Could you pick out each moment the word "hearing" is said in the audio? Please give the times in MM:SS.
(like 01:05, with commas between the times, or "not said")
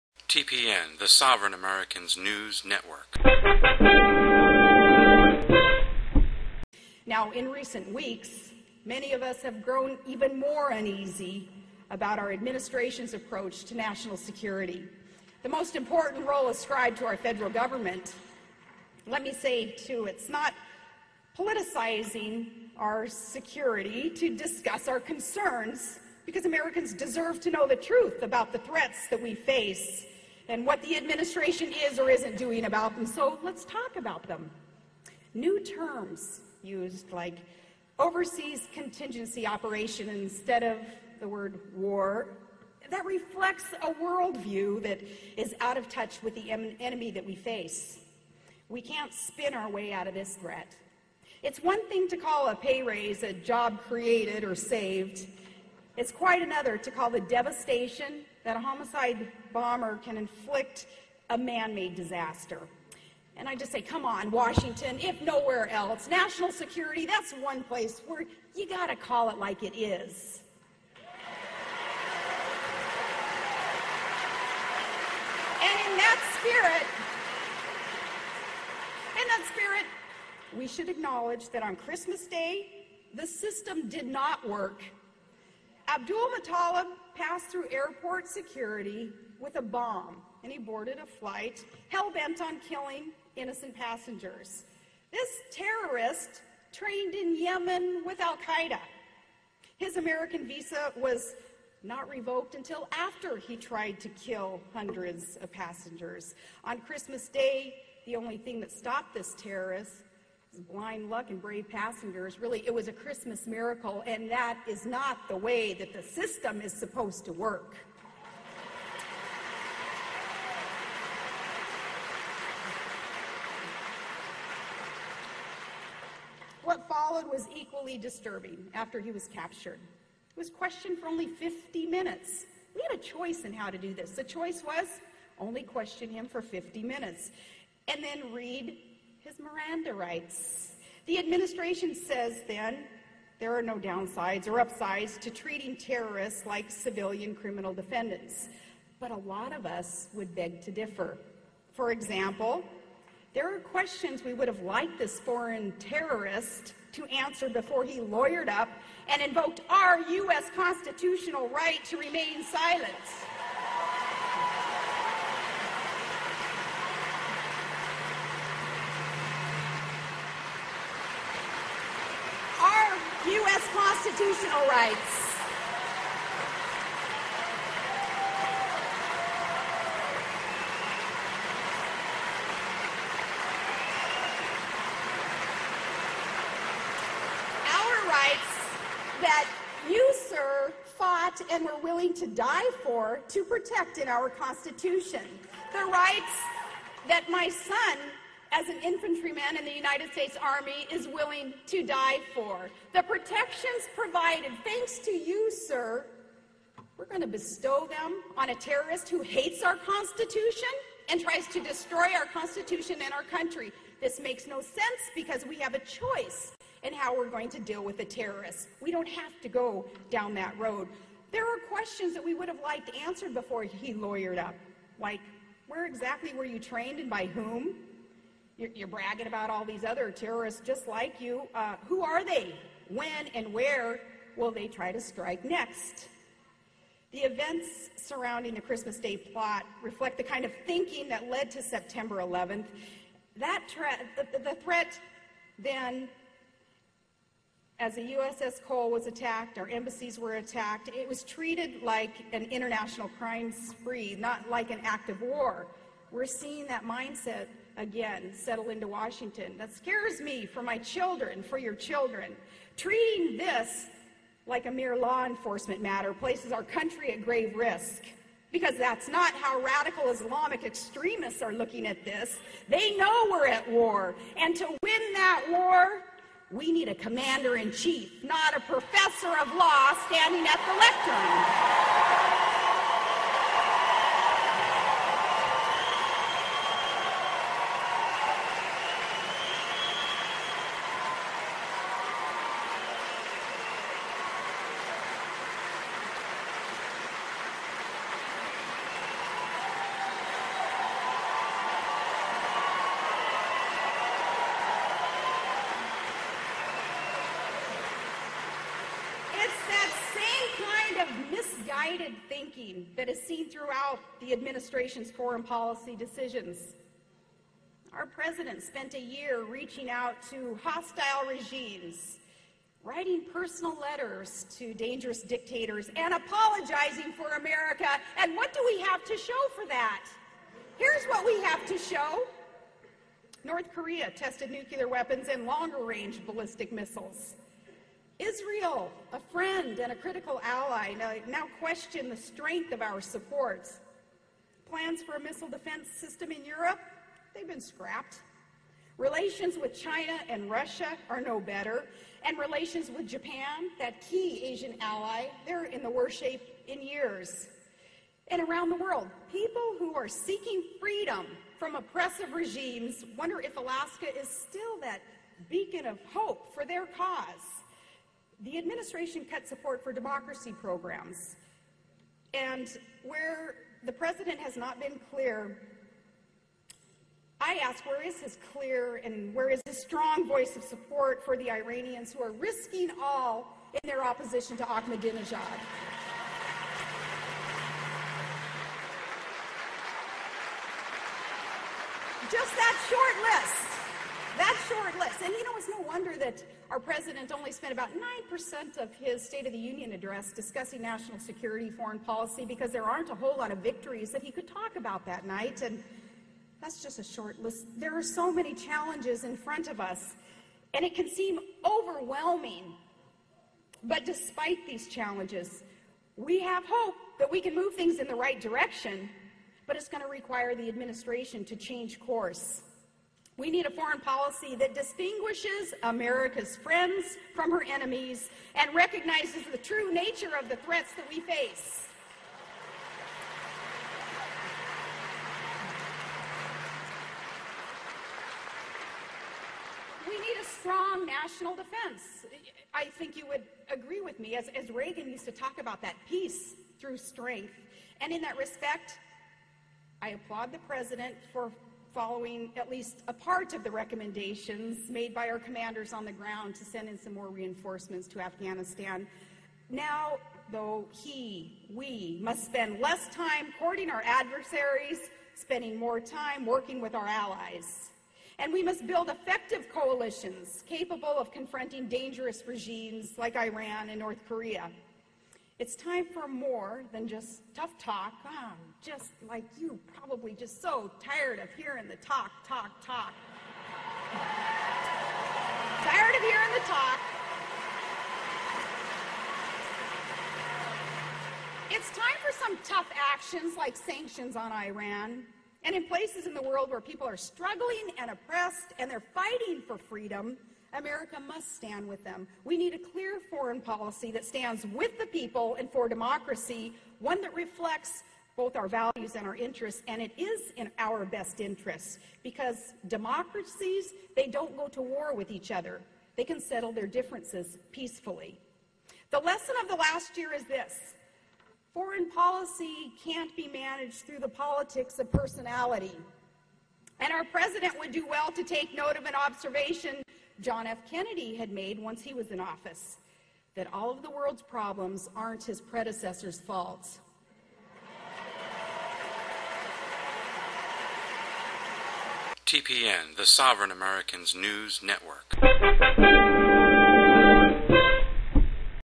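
08:01, 08:06.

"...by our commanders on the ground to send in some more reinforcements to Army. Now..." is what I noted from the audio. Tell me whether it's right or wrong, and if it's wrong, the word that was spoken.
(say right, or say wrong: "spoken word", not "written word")
wrong: "Afghanistan", not "Army".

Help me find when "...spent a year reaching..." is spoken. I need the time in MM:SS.
05:18.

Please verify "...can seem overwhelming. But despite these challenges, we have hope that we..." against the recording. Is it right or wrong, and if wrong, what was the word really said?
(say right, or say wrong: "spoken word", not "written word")
right.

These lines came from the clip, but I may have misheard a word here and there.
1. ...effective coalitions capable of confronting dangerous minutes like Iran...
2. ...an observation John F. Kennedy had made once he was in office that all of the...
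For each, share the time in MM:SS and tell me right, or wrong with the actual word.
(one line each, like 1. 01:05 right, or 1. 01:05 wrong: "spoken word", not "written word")
1. 07:49 wrong: "regimes", not "minutes"
2. 08:49 right.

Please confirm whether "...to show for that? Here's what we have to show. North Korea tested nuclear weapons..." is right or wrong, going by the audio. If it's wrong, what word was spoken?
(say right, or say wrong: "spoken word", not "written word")
right.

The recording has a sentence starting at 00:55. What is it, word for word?
It's quite another to call the devastation that a homicide bomber can inflict a man-made disaster.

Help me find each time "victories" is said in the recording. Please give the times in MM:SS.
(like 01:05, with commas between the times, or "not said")
06:43.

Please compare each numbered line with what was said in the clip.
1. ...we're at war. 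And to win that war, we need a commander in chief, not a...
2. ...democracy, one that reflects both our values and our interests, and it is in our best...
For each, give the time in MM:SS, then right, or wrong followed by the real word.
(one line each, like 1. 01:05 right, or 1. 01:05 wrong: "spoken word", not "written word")
1. 04:33 right
2. 08:25 right.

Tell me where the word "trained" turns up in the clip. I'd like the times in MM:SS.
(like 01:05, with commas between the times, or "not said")
01:36, 03:46.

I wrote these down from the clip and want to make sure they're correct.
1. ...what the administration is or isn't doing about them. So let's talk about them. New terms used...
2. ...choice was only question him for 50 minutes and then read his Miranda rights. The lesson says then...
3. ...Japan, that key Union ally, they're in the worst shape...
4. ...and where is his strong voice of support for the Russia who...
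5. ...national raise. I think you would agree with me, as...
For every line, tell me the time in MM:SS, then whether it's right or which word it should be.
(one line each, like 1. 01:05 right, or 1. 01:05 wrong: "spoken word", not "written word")
1. 00:30 right
2. 02:14 wrong: "administration", not "lesson"
3. 05:53 wrong: "Asian", not "Union"
4. 06:19 wrong: "Iranians", not "Russia"
5. 07:21 wrong: "defense", not "raise".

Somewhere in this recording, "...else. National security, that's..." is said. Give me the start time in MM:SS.
01:05.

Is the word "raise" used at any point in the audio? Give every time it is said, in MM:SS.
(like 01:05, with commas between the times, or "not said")
00:52.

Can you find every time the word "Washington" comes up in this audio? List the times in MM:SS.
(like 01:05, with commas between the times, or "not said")
01:04, 04:18.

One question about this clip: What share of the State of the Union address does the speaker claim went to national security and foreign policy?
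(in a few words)
9%.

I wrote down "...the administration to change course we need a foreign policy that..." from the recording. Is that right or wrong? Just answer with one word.
right.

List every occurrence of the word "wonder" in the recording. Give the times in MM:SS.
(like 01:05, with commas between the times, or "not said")
06:03, 06:35.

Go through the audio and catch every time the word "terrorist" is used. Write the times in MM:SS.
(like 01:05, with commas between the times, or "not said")
01:35, 01:49, 02:25, 02:35, 03:28, 03:38, 03:50.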